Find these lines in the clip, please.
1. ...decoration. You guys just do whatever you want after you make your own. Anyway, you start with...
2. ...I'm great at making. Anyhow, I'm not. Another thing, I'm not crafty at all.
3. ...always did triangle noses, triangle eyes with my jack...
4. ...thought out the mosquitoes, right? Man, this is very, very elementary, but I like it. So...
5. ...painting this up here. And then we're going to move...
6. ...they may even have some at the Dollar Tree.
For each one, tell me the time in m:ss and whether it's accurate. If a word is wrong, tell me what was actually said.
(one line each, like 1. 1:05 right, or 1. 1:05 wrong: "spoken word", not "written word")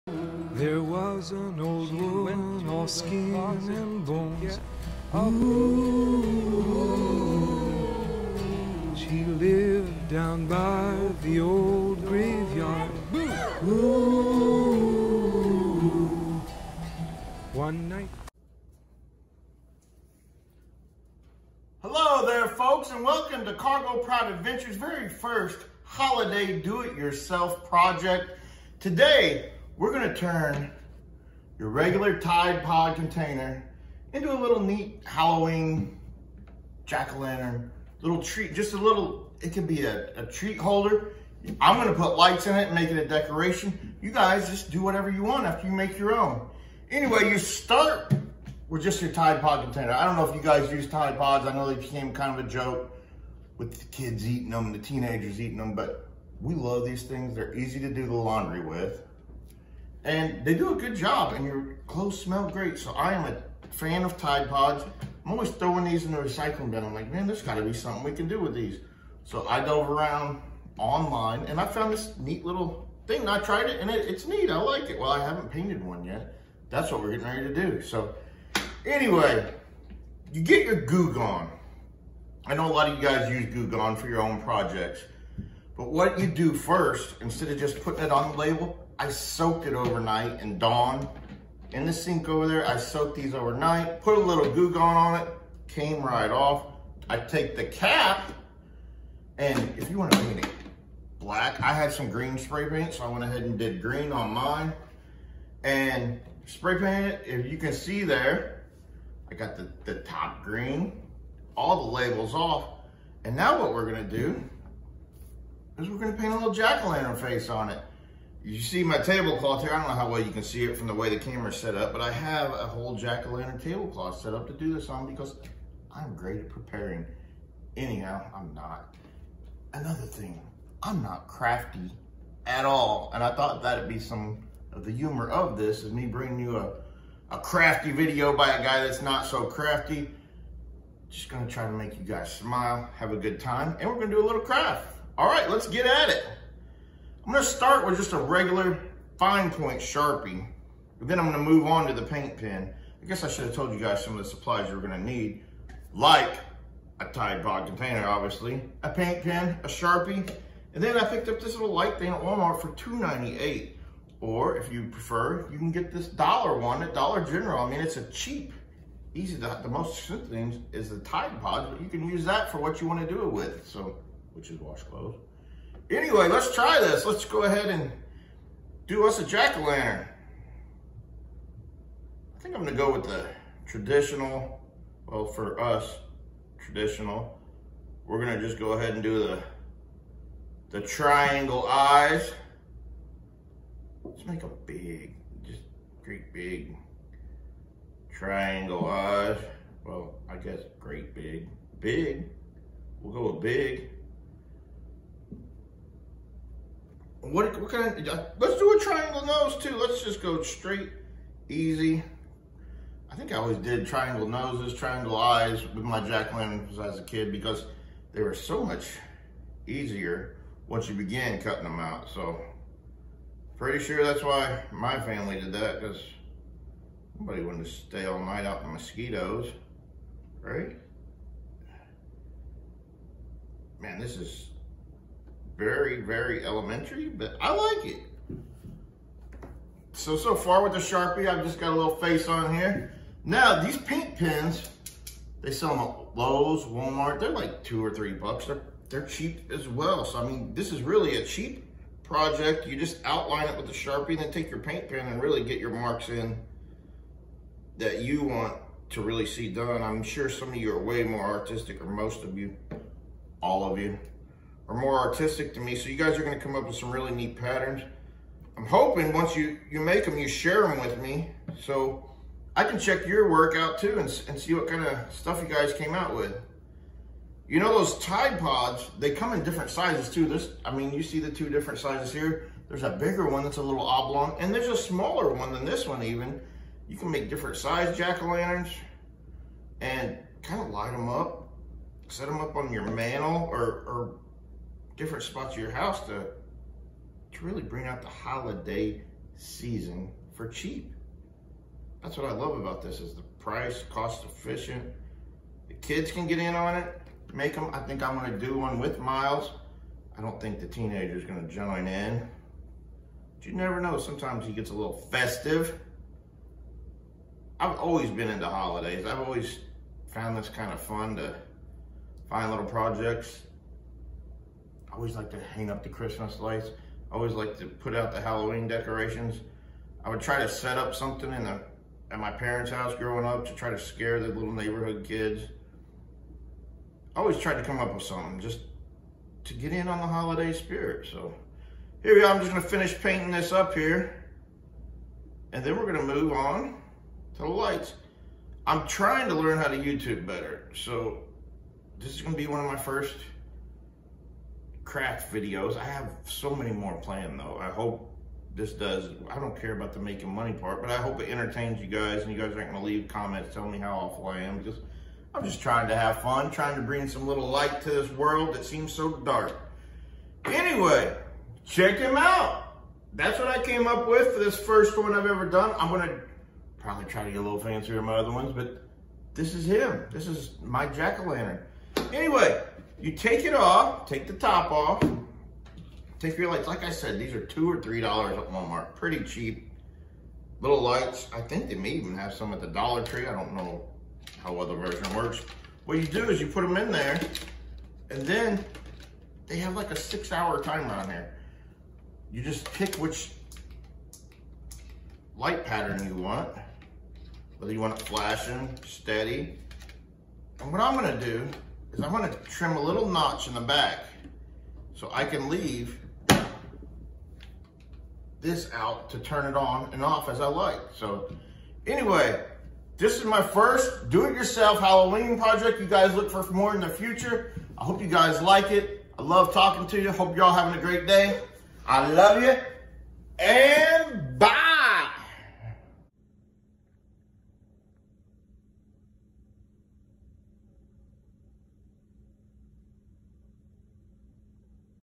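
1. 0:43 right
2. 2:05 wrong: "preparing", not "making"
3. 3:33 right
4. 3:48 wrong: "night", not "thought"
5. 5:42 right
6. 6:31 right.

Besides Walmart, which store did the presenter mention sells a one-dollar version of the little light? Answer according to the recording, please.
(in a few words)
Dollar General.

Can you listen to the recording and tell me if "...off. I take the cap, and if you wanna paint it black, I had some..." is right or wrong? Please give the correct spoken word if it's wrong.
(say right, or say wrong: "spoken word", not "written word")
right.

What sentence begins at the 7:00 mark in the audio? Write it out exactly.
So anyway, this is my first do-it-yourself Halloween project.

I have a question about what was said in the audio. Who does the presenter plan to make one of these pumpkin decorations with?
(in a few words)
Miles.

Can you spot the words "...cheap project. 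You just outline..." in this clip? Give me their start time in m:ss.
4:11.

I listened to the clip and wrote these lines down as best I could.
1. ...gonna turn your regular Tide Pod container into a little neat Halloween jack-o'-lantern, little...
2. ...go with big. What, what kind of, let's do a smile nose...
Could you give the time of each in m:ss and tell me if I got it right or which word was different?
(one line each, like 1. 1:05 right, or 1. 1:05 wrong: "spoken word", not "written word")
1. 0:29 right
2. 3:23 wrong: "triangle", not "smile".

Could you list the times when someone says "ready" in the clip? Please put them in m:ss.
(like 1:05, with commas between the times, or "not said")
1:17.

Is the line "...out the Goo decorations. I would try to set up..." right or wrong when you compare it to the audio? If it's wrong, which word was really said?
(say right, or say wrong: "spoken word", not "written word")
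wrong: "Halloween", not "Goo".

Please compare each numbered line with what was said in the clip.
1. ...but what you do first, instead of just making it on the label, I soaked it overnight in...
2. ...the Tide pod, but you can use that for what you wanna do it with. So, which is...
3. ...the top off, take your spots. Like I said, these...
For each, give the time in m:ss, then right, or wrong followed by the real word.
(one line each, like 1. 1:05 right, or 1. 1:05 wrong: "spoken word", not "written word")
1. 1:25 wrong: "putting", not "making"
2. 2:50 right
3. 6:24 wrong: "lights", not "spots".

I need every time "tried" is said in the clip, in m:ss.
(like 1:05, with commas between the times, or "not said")
1:13, 5:37.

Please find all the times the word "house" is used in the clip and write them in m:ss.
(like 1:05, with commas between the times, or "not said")
4:55, 5:32.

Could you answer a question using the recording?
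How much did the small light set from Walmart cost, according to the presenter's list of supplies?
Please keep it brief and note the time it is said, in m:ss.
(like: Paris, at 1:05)
$2.98, at 2:42.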